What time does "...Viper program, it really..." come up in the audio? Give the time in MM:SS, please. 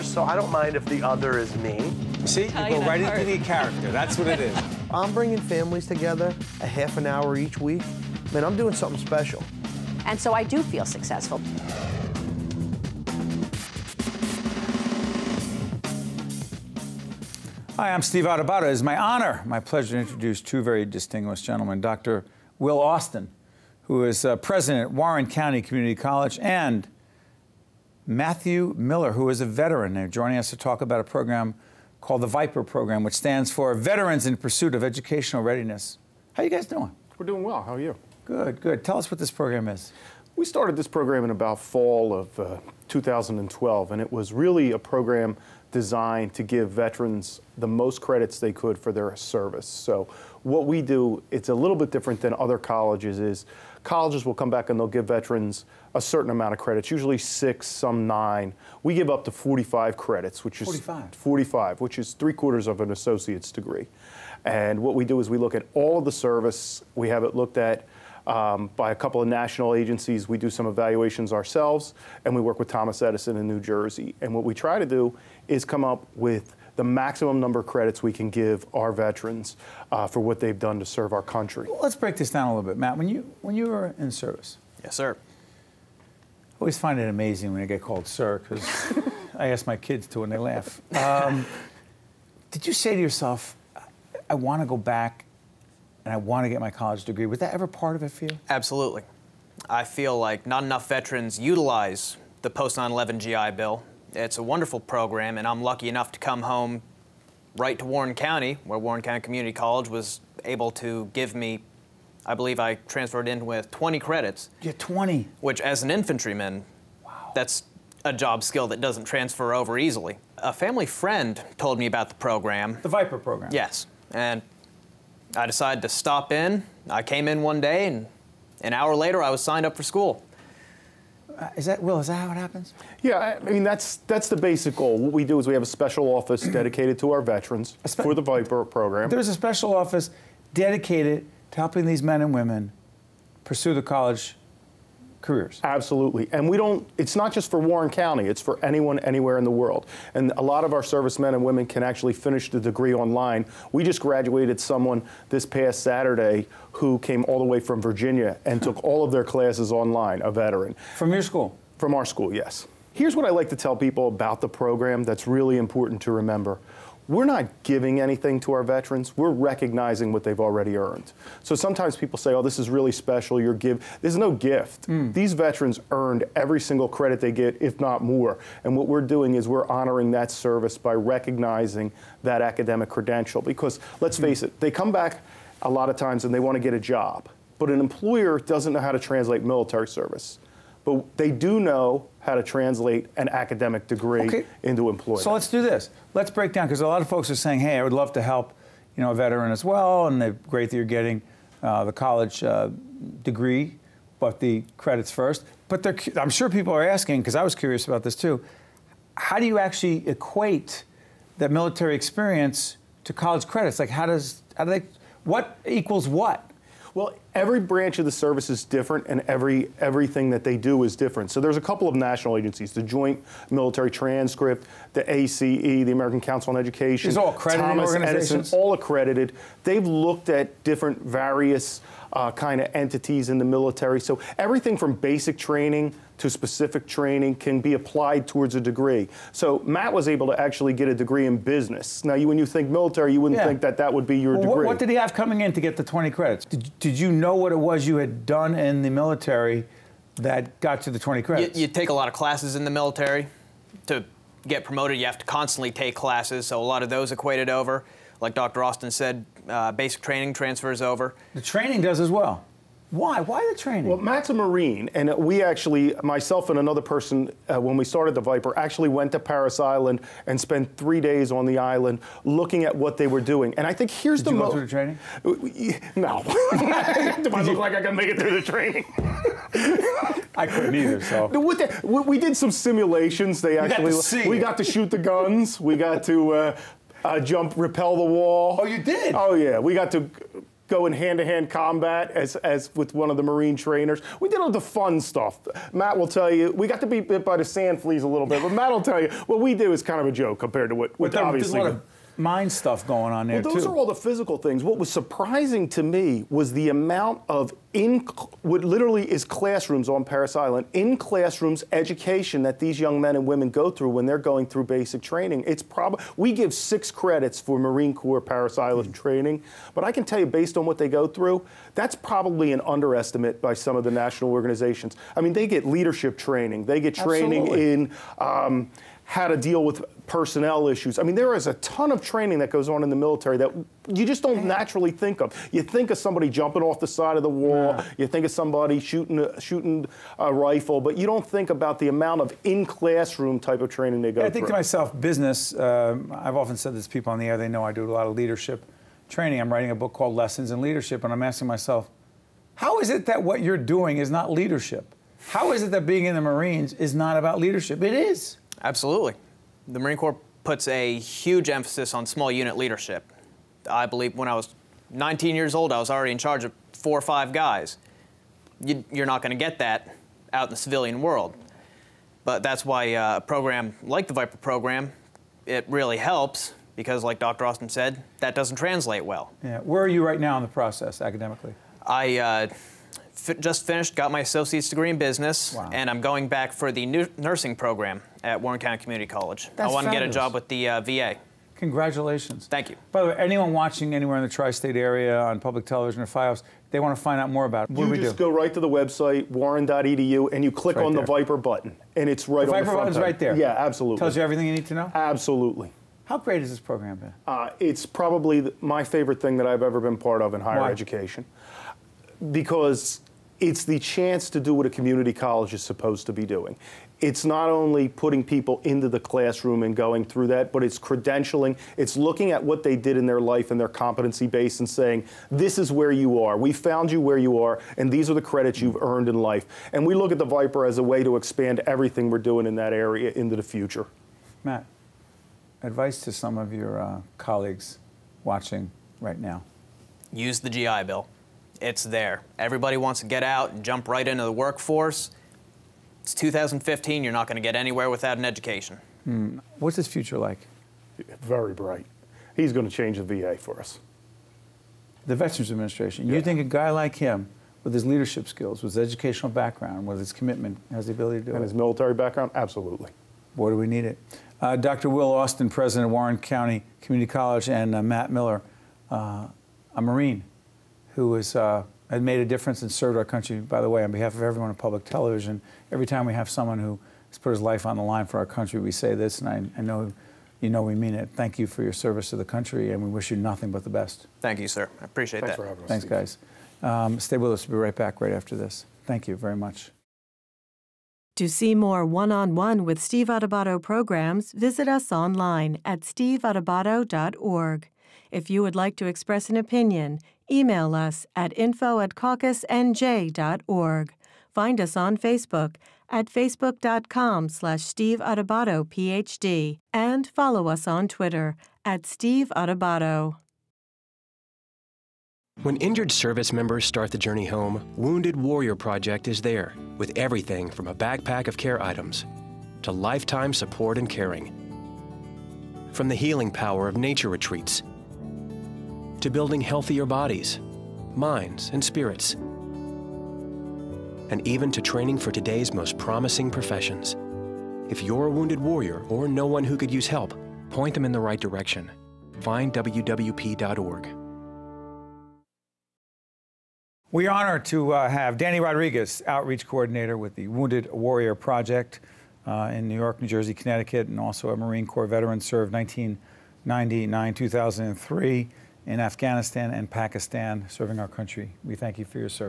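06:14.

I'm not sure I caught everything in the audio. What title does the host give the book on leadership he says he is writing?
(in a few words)
Lessons in Leadership.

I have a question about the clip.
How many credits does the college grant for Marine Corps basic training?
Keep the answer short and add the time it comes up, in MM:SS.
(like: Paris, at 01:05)
6, at 05:16.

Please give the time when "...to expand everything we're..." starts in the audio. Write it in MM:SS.
07:11.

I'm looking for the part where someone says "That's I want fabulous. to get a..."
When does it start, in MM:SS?
06:29.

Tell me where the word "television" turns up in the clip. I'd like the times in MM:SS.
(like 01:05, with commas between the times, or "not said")
06:35, 07:54.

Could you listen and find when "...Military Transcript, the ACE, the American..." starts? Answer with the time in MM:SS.
03:43.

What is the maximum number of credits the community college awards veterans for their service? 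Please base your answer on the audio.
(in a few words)
45.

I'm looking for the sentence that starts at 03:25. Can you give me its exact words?
But I'm sure people are asking because I was curious about this too.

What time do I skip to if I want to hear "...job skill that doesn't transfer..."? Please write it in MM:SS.
01:58.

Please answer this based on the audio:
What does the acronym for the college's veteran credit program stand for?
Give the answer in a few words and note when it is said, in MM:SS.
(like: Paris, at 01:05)
Veterans in Pursuit of Educational Readiness, at 00:33.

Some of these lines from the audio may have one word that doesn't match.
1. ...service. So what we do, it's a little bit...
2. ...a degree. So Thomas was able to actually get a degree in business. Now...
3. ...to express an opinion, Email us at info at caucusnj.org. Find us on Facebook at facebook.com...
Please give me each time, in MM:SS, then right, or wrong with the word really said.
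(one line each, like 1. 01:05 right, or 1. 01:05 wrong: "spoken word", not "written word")
1. 00:49 right
2. 03:58 wrong: "Matt", not "Thomas"
3. 08:18 right.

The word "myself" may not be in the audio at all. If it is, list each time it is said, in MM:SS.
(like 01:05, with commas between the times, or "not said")
04:26, 05:44, 05:51.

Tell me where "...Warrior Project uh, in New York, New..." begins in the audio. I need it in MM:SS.
09:10.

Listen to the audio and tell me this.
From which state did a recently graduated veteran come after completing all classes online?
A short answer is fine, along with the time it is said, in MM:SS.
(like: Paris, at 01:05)
Virginia, at 02:37.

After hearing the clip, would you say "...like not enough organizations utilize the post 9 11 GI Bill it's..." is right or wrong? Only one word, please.
wrong.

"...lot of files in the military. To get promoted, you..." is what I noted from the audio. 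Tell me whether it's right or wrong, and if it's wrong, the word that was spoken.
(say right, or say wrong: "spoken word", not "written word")
wrong: "classes", not "files".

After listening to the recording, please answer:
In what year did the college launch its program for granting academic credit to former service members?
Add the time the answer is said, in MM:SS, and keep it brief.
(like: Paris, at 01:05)
2012, at 00:42.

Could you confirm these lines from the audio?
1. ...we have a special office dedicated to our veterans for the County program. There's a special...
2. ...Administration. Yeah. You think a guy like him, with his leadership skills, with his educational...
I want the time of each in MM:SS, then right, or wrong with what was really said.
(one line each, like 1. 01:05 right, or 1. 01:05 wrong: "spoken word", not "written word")
1. 02:15 wrong: "Viper", not "County"
2. 07:35 right.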